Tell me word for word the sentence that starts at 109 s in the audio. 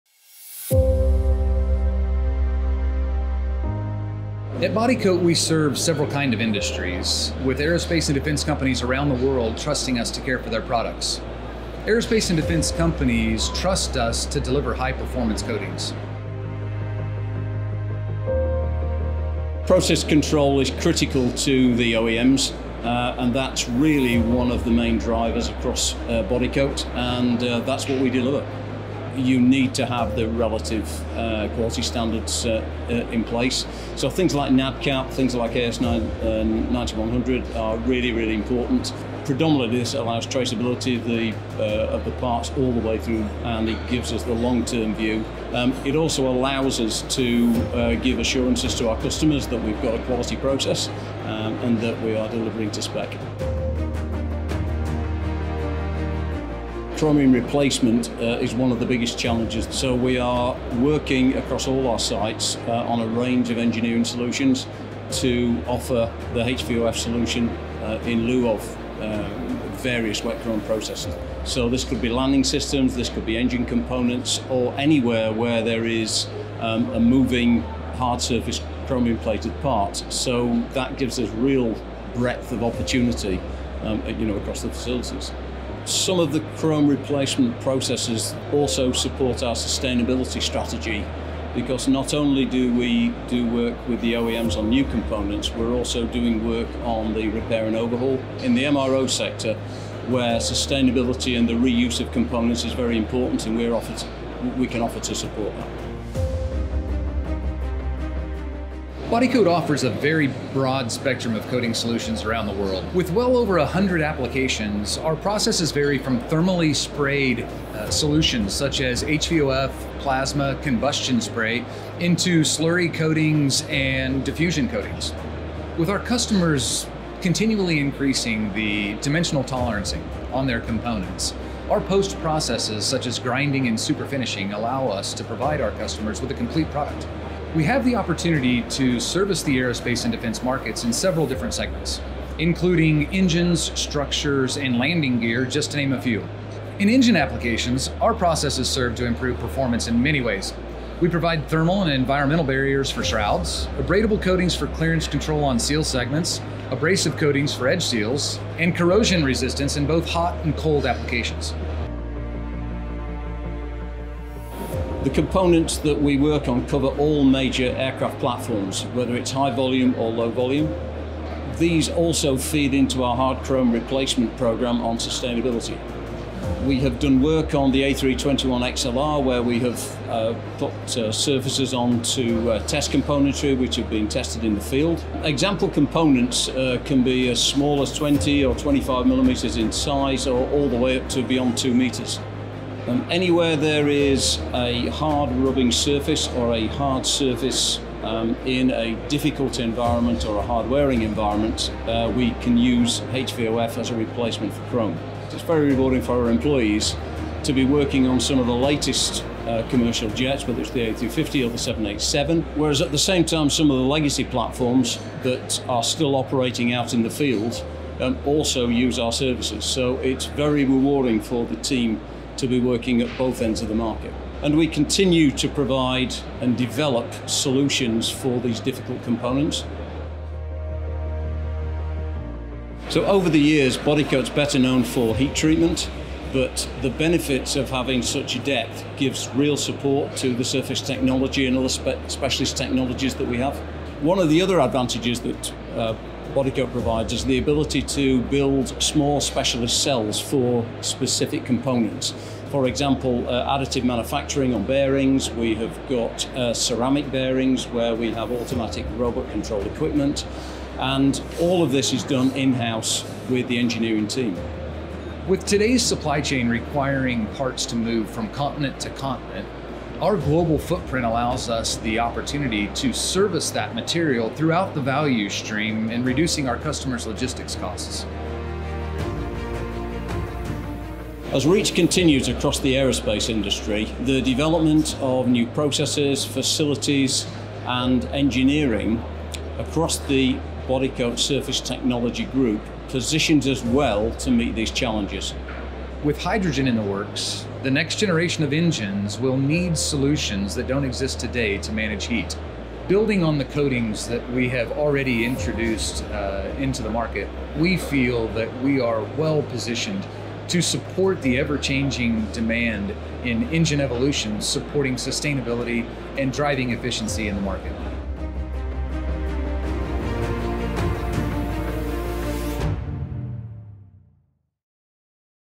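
Bodycote offers a very broad spectrum of coating solutions around the world.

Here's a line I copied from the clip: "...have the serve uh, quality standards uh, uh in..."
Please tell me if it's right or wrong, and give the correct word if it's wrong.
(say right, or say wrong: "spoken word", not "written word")
wrong: "relative", not "serve".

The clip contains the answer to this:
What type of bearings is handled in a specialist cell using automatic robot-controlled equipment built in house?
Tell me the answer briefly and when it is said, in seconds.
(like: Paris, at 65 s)
ceramic bearings, at 256 s.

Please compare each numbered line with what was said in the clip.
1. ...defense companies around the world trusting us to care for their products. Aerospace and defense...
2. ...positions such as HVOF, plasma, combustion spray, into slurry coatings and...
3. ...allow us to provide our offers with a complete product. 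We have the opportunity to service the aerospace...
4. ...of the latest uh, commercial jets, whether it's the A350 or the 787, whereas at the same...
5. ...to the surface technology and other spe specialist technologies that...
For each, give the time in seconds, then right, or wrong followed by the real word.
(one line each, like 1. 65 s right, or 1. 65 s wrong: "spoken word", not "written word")
1. 8 s right
2. 117 s wrong: "solutions", not "positions"
3. 134 s wrong: "customers", not "offers"
4. 208 s right
5. 240 s right.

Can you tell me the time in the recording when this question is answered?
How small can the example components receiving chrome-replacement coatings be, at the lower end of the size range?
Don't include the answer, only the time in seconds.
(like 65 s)
187 s.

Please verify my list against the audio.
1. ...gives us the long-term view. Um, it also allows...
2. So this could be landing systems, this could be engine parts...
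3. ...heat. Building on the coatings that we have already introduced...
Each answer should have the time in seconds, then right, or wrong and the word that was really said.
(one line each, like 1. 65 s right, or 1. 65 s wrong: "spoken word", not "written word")
1. 43 s right
2. 71 s wrong: "components", not "parts"
3. 302 s right.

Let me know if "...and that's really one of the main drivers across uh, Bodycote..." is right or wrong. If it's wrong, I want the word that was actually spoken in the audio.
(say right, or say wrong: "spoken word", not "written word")
right.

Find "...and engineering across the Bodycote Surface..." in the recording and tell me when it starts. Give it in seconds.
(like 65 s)
287 s.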